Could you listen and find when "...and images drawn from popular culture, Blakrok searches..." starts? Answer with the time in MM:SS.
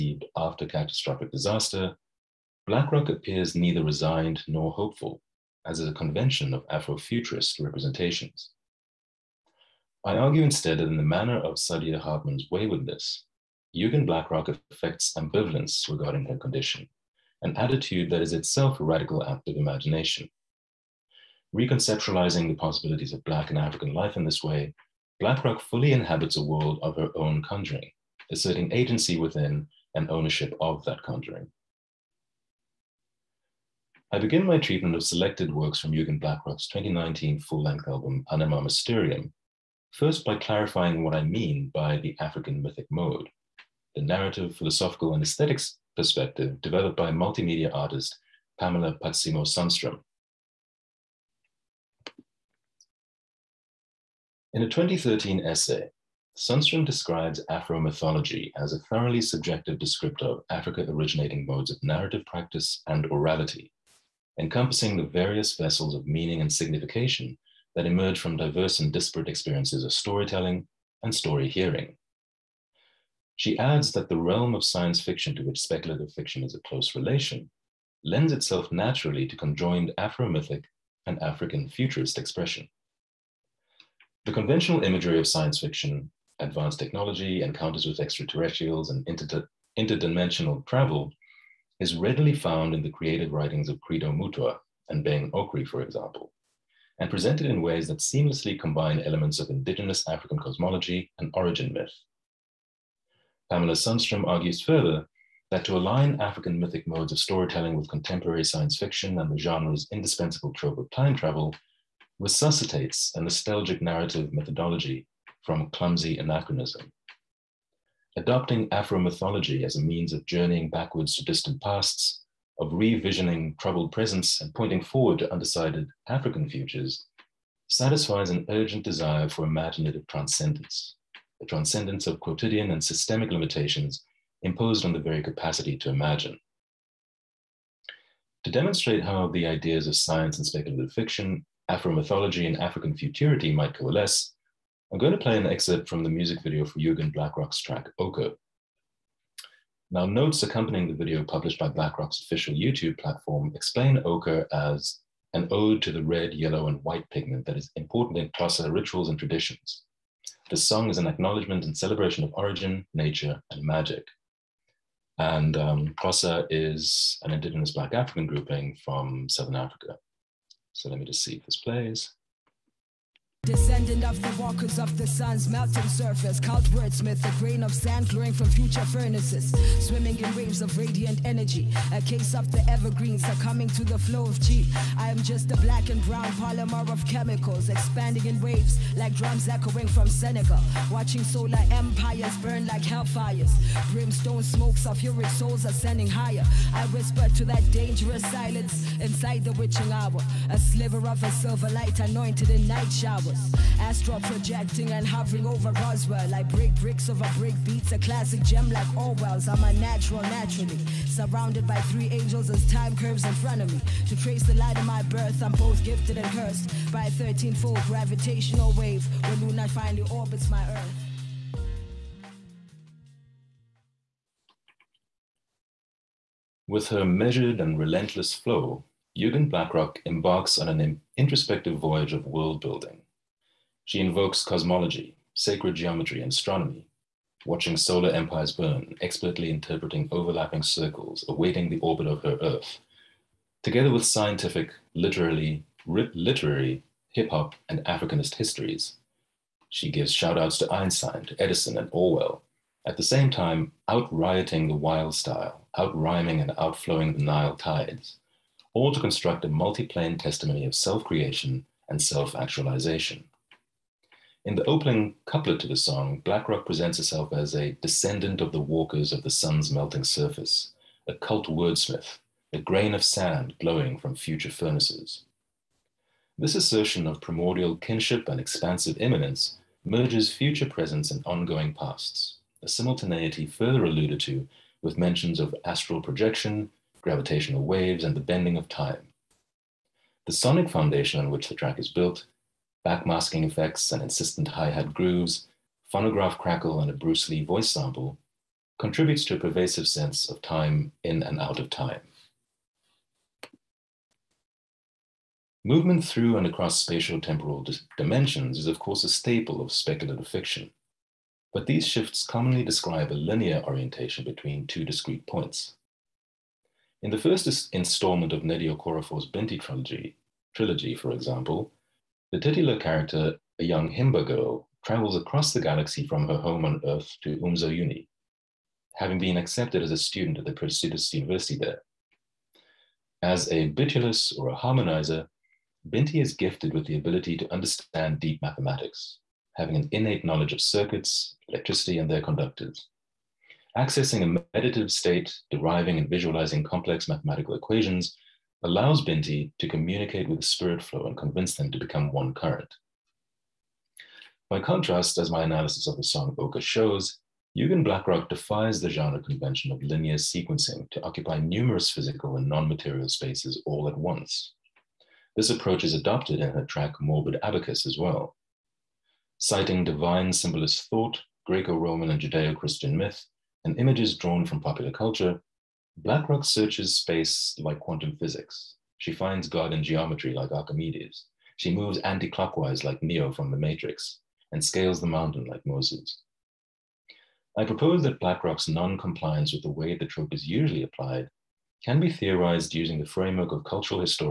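06:13.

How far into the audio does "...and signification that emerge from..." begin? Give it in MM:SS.
01:06.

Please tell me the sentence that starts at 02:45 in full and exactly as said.
And um, is an indigenous Black African grouping from Southern Africa.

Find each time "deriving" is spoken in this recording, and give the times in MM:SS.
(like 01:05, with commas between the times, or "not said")
05:45.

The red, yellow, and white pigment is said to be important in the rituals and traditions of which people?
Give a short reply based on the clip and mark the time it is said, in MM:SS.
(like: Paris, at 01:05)
Xhosa, at 02:38.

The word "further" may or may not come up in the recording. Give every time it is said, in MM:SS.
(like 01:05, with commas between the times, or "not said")
01:44, 04:43.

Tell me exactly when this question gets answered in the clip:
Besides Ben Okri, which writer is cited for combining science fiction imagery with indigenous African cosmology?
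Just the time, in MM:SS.
01:33.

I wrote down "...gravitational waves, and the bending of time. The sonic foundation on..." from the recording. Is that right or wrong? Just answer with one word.
right.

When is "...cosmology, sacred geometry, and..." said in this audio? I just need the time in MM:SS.
03:54.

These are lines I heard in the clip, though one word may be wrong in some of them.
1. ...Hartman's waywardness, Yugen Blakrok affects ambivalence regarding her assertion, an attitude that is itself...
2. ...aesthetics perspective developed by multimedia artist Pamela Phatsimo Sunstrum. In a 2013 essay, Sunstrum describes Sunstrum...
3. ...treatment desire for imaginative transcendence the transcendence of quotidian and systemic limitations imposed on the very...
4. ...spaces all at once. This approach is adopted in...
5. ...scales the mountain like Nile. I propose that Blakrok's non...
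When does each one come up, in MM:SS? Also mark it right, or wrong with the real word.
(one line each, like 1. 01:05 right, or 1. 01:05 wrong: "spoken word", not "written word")
1. 00:11 wrong: "condition", not "assertion"
2. 00:45 wrong: "Afro", not "Sunstrum"
3. 02:08 wrong: "urgent", not "treatment"
4. 06:03 right
5. 06:24 wrong: "Moses", not "Nile".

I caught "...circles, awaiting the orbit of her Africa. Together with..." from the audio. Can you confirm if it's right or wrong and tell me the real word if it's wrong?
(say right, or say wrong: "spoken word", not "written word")
wrong: "Earth", not "Africa".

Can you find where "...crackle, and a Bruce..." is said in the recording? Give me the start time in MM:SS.
04:56.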